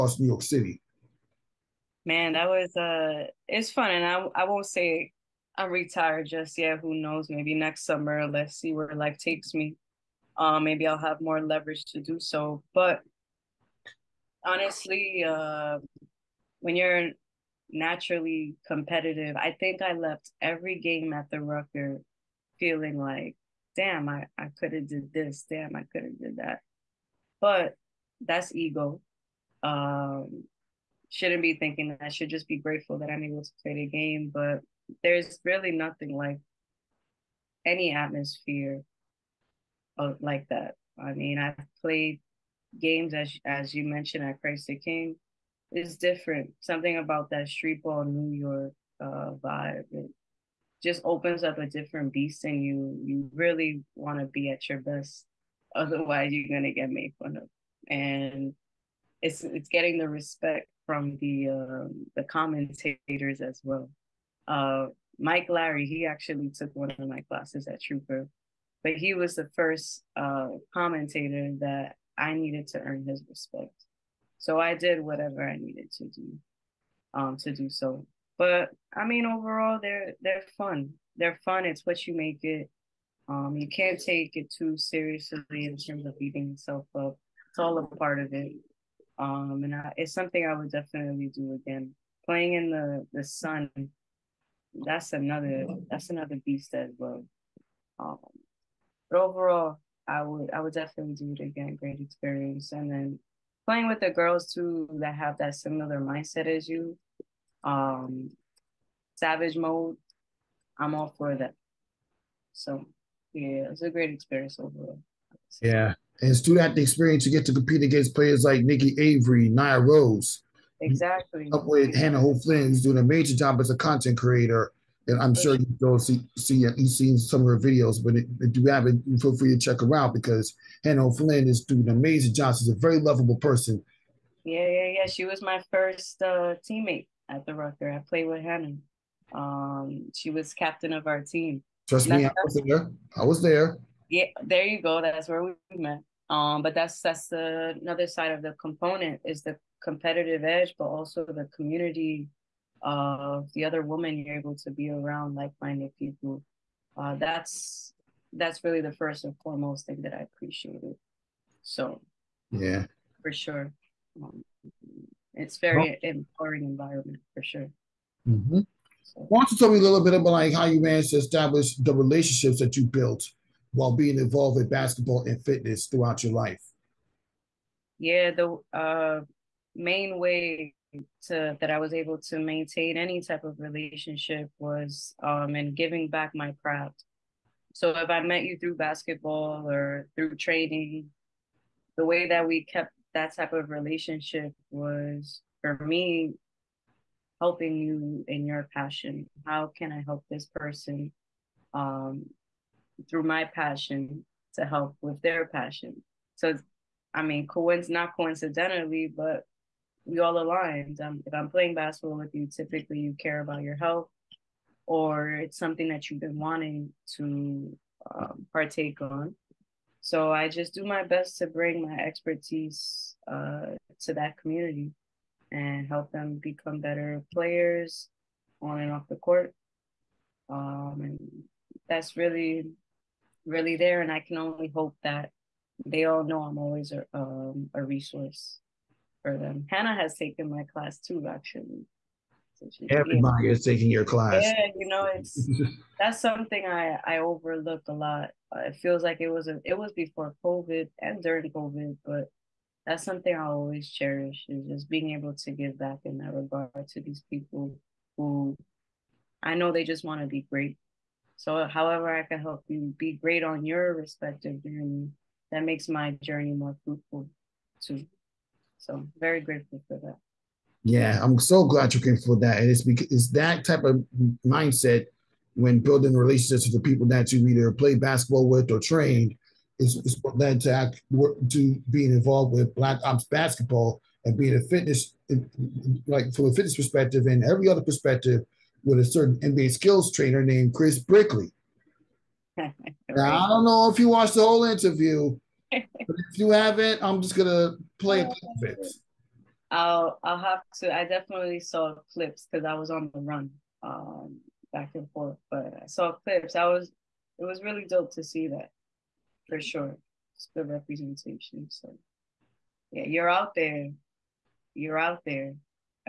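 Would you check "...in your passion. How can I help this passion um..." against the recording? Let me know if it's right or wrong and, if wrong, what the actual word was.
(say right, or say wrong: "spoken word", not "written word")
wrong: "person", not "passion".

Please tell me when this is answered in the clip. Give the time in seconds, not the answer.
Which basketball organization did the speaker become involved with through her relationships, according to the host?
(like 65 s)
282 s.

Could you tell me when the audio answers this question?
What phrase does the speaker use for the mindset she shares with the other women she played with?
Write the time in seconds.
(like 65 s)
109 s.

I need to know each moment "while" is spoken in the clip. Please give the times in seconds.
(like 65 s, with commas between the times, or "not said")
173 s.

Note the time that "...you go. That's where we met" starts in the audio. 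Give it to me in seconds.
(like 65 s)
144 s.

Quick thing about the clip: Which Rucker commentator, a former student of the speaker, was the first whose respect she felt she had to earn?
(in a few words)
Mike Larry.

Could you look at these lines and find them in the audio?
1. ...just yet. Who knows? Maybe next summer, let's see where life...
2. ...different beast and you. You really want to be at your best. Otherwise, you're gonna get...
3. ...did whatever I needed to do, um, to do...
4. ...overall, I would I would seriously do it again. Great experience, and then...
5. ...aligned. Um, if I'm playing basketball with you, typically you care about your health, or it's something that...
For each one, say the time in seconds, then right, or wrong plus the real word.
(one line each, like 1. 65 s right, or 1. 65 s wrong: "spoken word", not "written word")
1. 6 s right
2. 51 s right
3. 74 s right
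4. 99 s wrong: "definitely", not "seriously"
5. 210 s right.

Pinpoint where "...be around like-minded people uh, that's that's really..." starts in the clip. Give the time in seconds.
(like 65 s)
154 s.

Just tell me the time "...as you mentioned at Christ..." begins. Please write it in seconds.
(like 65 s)
43 s.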